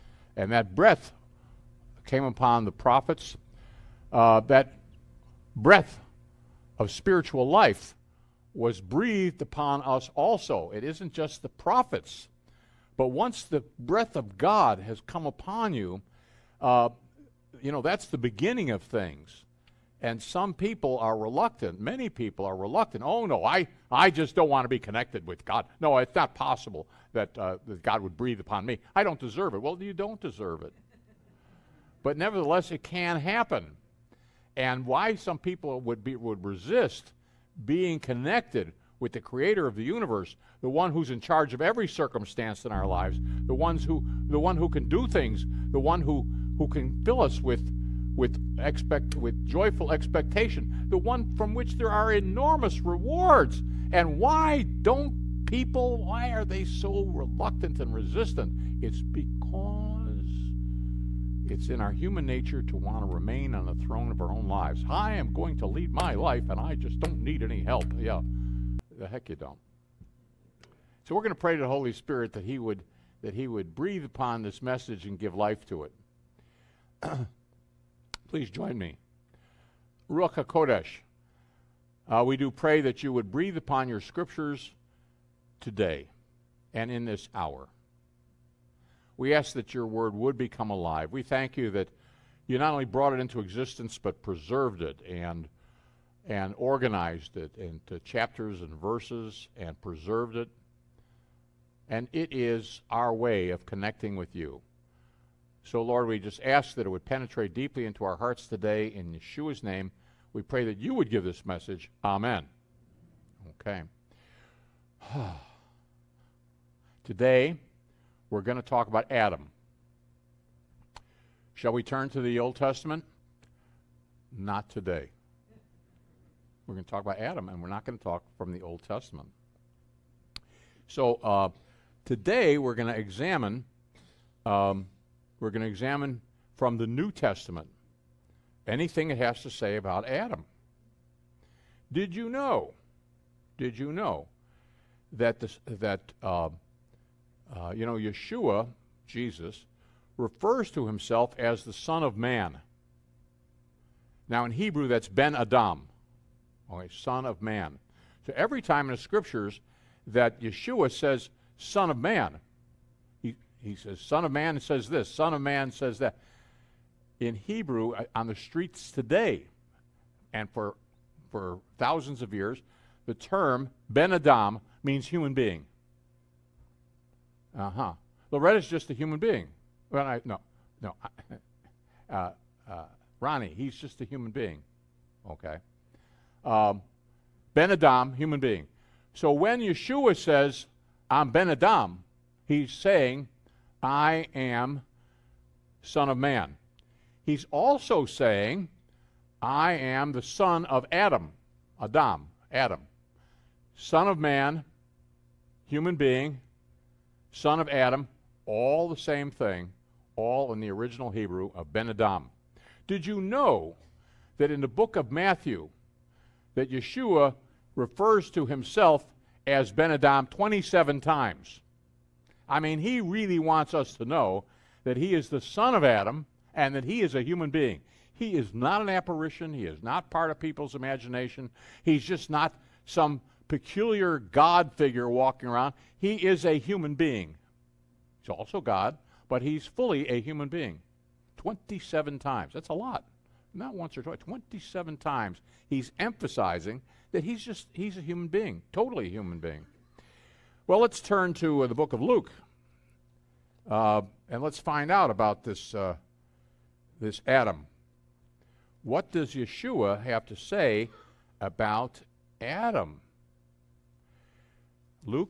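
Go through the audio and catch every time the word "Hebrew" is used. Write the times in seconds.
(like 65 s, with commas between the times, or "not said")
154 s, 167 s, 211 s.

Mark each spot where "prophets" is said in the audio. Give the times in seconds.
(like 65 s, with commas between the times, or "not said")
2 s, 11 s.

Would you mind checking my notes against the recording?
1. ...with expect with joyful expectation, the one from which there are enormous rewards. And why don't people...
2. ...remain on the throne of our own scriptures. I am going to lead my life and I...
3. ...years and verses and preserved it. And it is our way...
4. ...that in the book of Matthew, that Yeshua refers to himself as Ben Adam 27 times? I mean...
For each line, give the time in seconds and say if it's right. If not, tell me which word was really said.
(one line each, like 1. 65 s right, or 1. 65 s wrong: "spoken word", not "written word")
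1. 48 s right
2. 63 s wrong: "lives", not "scriptures"
3. 98 s wrong: "chapters", not "years"
4. 214 s right.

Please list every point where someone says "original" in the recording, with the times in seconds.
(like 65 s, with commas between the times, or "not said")
210 s.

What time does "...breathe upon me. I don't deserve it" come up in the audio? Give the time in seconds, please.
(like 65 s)
28 s.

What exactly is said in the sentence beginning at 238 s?
He's also God, but he's fully a human being.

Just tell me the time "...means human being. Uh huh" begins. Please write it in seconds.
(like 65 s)
174 s.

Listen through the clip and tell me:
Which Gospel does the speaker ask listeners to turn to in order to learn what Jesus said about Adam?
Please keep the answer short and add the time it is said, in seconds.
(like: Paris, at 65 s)
Luke, at 251 s.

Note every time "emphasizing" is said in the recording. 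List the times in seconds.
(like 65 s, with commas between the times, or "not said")
245 s.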